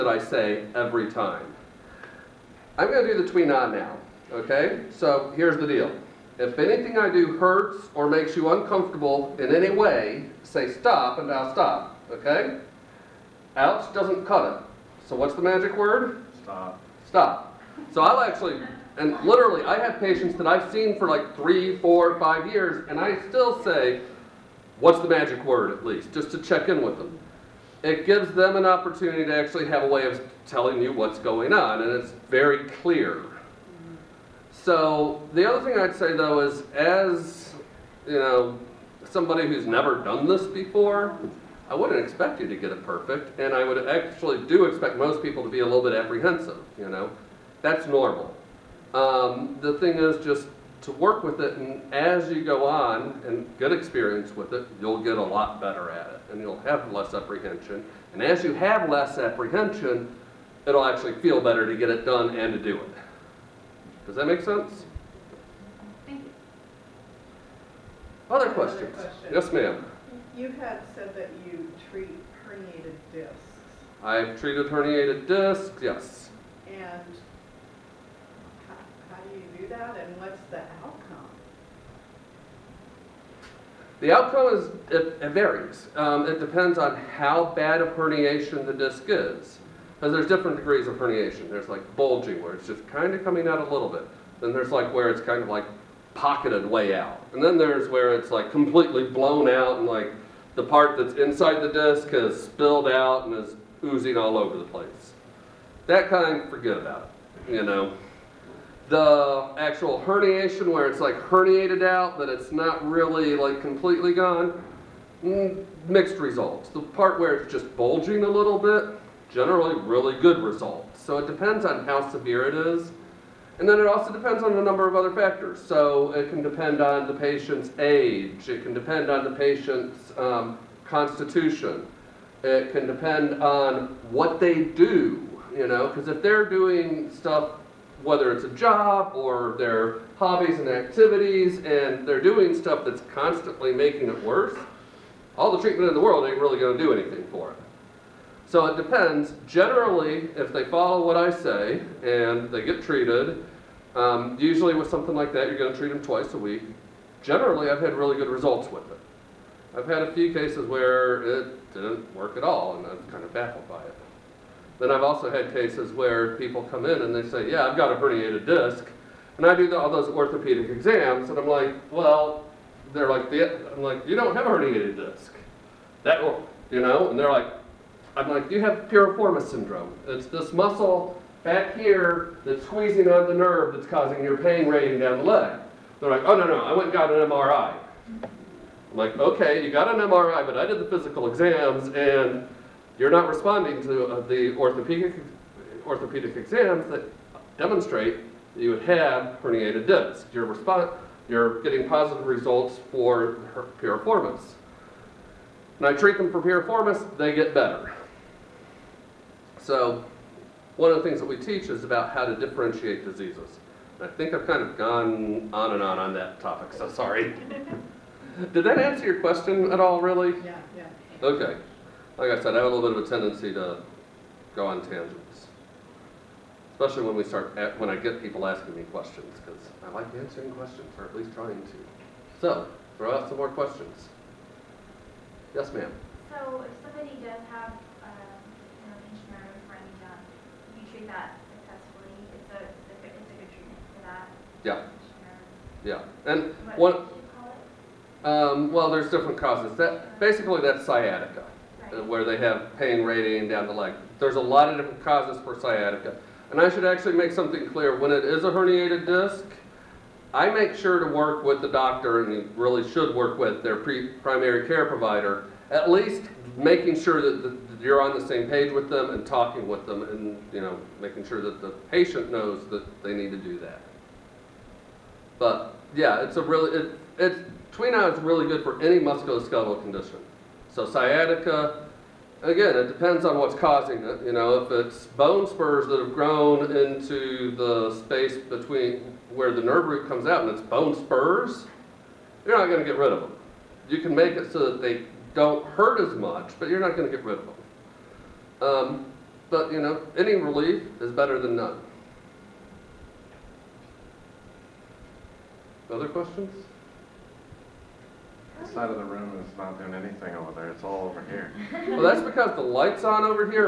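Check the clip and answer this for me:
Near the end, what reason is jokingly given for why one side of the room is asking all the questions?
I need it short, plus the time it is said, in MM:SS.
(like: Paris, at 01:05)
the light's on, at 05:12.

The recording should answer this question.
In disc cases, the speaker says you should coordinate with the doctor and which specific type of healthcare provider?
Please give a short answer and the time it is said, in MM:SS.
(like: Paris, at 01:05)
primary care provider, at 04:23.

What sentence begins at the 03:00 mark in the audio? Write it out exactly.
It's this muscle back here that's squeezing on the nerve that's causing your pain radiating down the leg.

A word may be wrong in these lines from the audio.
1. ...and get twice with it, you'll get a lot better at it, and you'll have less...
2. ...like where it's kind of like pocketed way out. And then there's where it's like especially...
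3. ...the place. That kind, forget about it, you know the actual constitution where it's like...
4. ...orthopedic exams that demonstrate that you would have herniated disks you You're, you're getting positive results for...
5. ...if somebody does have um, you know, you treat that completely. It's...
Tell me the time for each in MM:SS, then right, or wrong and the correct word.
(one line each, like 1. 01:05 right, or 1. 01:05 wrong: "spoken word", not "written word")
1. 00:53 wrong: "experience", not "twice"
2. 01:34 wrong: "completely", not "especially"
3. 01:44 wrong: "herniation", not "constitution"
4. 03:15 right
5. 03:56 wrong: "successfully", not "completely".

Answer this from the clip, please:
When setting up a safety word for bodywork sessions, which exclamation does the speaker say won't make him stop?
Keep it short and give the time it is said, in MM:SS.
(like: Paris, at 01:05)
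Ouch, at 00:13.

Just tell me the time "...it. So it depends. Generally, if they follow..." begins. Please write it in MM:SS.
02:27.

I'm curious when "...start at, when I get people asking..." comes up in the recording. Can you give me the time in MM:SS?
03:47.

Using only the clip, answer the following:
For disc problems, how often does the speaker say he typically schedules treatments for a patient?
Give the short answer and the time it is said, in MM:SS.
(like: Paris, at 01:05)
twice a week, at 02:36.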